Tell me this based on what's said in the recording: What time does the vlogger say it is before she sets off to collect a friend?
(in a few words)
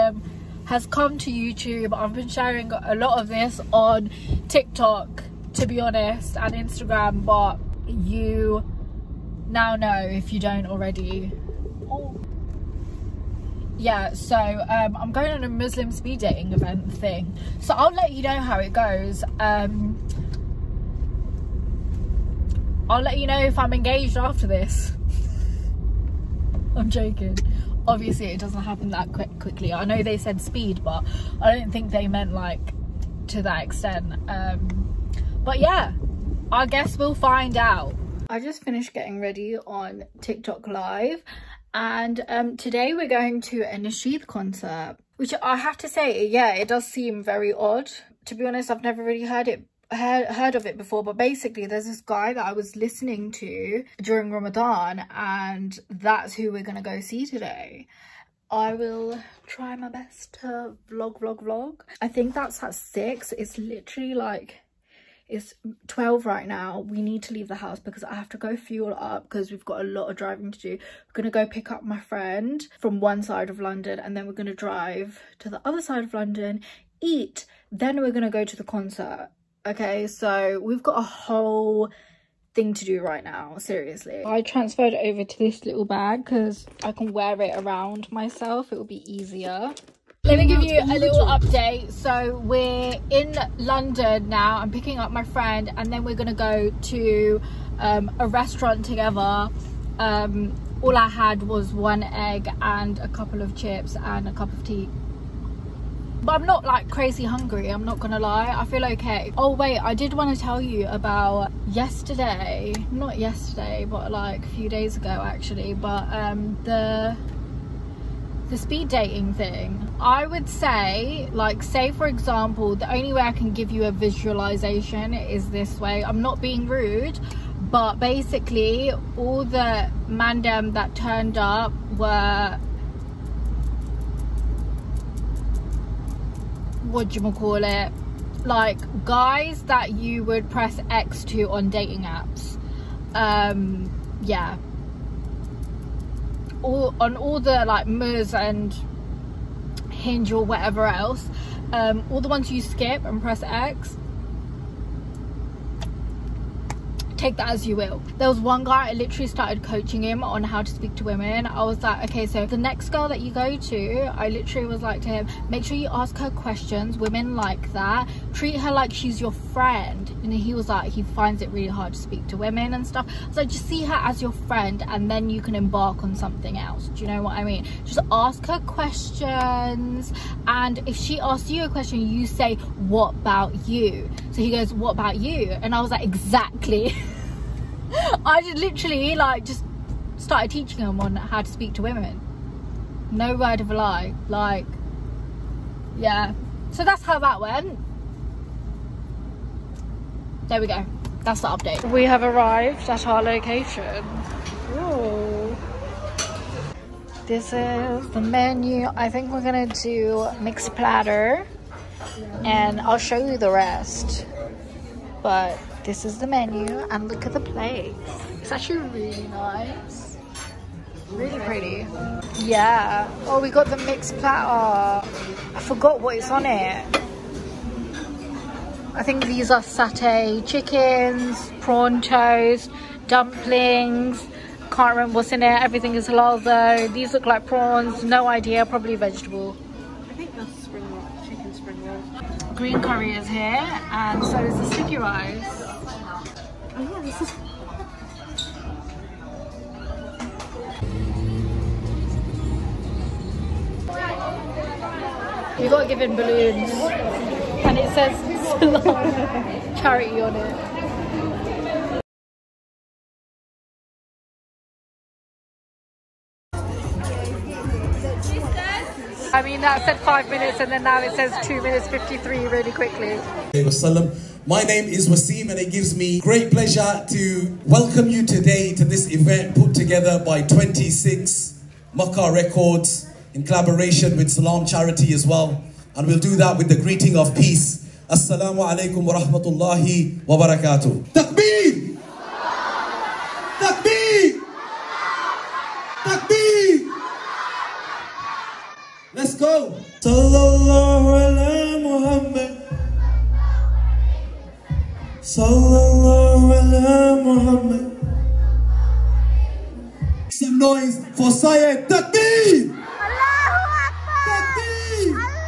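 12.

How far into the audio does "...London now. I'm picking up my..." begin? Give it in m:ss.
1:33.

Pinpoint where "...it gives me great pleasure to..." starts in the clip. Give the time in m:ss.
4:35.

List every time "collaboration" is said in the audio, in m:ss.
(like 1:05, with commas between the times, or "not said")
4:43.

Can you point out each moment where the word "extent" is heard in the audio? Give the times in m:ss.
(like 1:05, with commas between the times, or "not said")
0:33.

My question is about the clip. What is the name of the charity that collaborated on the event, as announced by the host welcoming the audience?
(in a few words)
Salam Charity.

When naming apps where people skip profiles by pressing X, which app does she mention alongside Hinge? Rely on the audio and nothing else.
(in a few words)
Muzz.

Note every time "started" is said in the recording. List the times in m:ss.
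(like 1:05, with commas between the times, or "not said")
2:39, 3:10.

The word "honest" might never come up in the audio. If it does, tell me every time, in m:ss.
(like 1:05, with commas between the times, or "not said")
0:05, 0:48.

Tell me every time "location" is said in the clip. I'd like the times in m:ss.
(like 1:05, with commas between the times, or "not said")
3:23.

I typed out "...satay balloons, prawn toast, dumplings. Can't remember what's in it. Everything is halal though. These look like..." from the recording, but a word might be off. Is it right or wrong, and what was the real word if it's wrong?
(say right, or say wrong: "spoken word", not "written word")
wrong: "chickens", not "balloons".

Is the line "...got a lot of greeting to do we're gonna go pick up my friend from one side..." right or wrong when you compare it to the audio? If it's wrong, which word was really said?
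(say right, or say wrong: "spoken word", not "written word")
wrong: "driving", not "greeting".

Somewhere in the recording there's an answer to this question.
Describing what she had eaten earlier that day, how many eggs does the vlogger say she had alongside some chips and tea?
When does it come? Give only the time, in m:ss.
1:41.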